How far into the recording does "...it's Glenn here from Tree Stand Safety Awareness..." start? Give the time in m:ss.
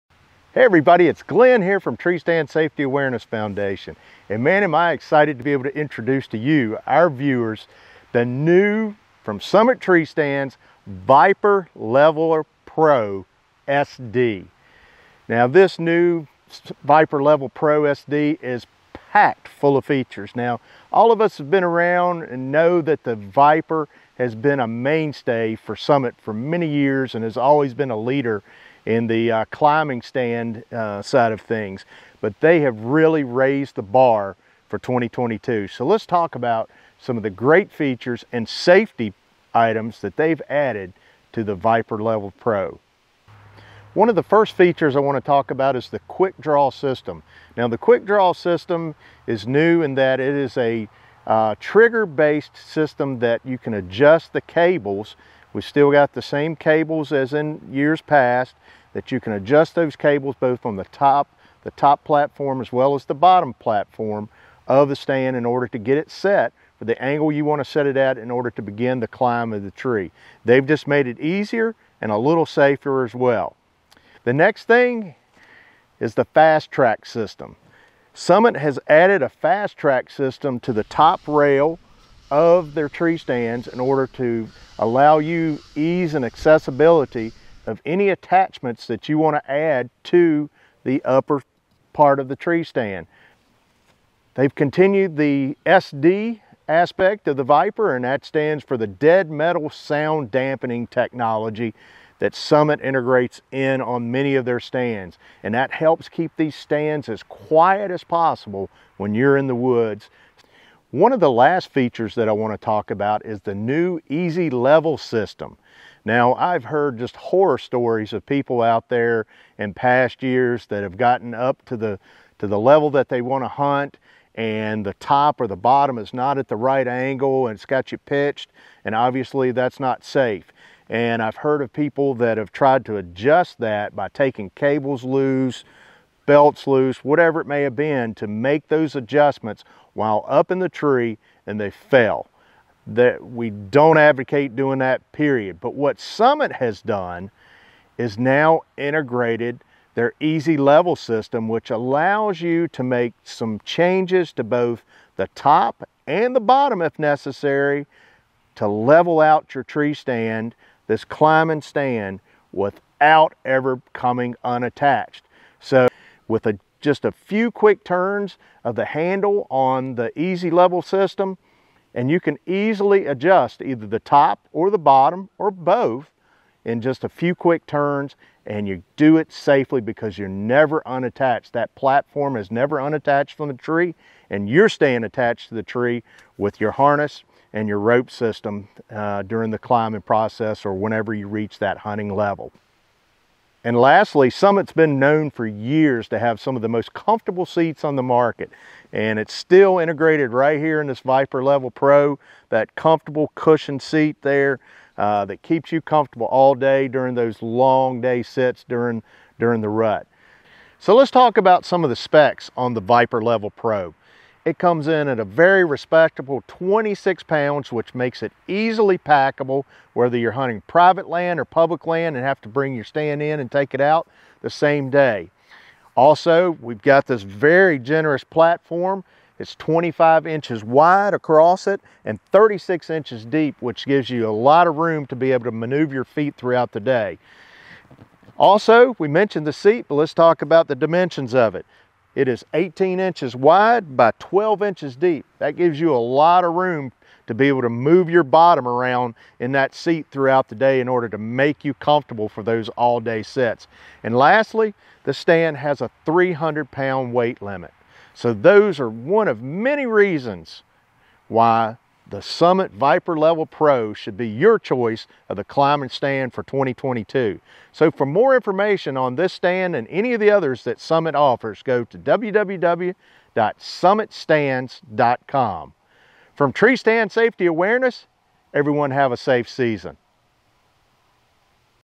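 0:01.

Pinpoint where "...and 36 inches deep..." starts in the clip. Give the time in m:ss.
3:52.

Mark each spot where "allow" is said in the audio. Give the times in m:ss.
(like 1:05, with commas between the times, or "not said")
1:24, 2:31.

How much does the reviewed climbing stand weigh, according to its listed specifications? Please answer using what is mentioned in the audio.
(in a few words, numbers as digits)
26 pounds.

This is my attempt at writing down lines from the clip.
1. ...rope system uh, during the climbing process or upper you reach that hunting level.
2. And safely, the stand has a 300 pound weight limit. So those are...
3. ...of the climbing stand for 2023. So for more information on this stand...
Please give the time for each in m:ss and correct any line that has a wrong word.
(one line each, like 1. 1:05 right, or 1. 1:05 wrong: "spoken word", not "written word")
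1. 3:07 wrong: "whenever", not "upper"
2. 4:14 wrong: "lastly", not "safely"
3. 4:25 wrong: "2022", not "2023".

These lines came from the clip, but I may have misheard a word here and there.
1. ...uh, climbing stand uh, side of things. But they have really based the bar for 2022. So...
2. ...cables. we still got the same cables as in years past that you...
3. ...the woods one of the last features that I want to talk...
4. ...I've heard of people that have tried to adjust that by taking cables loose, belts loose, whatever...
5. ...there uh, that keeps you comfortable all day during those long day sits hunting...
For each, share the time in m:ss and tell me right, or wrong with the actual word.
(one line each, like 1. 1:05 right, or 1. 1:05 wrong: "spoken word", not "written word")
1. 0:29 wrong: "raised", not "based"
2. 0:54 right
3. 1:49 right
4. 2:11 right
5. 3:24 wrong: "during", not "hunting".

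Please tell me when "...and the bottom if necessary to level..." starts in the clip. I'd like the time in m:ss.
2:36.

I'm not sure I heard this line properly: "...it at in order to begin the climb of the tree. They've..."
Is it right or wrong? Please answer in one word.
right.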